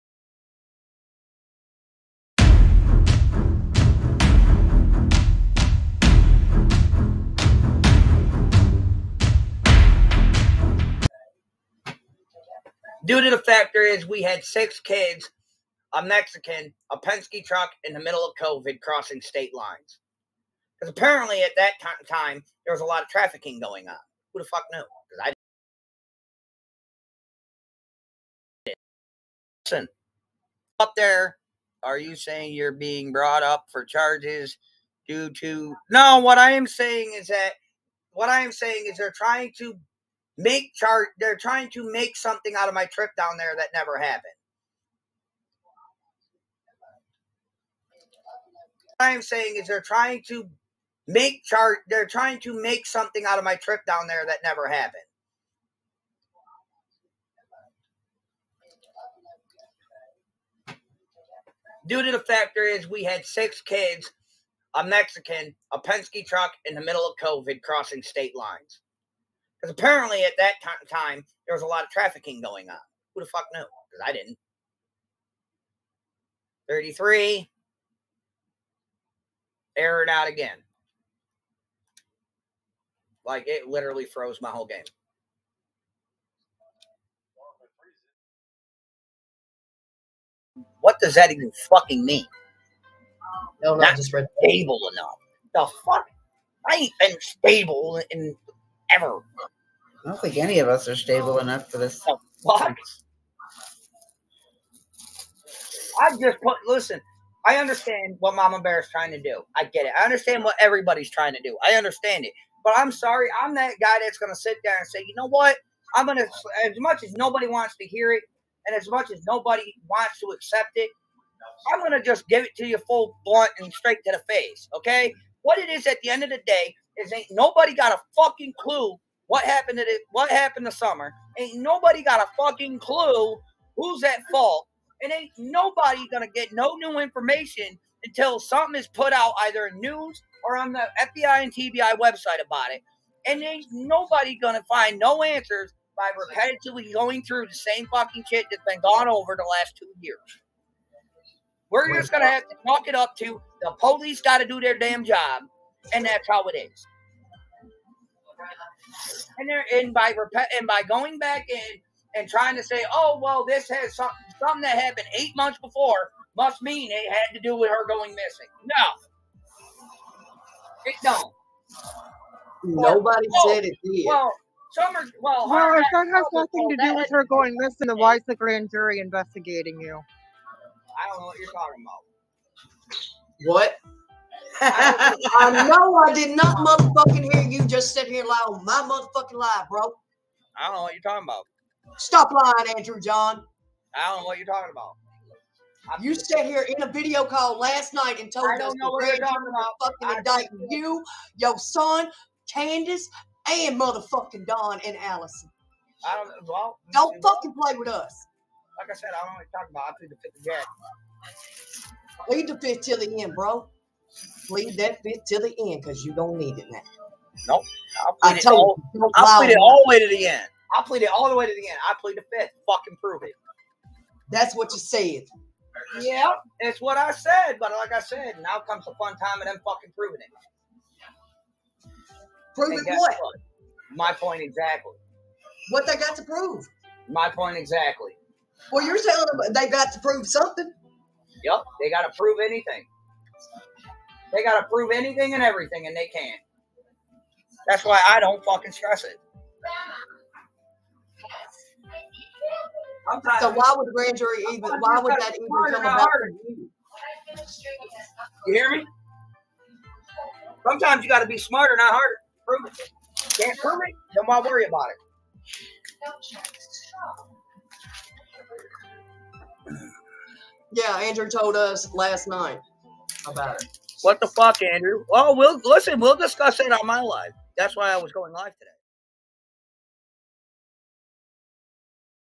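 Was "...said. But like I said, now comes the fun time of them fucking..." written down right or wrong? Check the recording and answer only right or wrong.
right.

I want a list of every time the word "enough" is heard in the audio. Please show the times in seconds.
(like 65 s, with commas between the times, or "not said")
94 s, 101 s.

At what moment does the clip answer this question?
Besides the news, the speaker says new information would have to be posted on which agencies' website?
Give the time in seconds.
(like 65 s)
140 s.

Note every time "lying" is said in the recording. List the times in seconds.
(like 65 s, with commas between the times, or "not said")
192 s.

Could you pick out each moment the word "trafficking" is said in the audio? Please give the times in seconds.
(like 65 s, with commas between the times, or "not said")
23 s, 71 s.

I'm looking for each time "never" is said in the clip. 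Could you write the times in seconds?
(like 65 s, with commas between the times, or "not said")
43 s, 54 s.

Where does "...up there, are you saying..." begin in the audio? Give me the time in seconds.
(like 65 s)
30 s.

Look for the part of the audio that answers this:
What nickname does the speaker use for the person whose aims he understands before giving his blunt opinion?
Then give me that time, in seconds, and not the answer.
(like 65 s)
108 s.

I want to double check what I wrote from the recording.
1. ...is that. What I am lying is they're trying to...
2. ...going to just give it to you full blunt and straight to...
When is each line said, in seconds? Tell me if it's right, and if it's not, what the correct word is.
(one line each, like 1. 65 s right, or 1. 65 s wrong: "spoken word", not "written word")
1. 37 s wrong: "saying", not "lying"
2. 121 s right.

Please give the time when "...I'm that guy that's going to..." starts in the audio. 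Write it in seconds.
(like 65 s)
113 s.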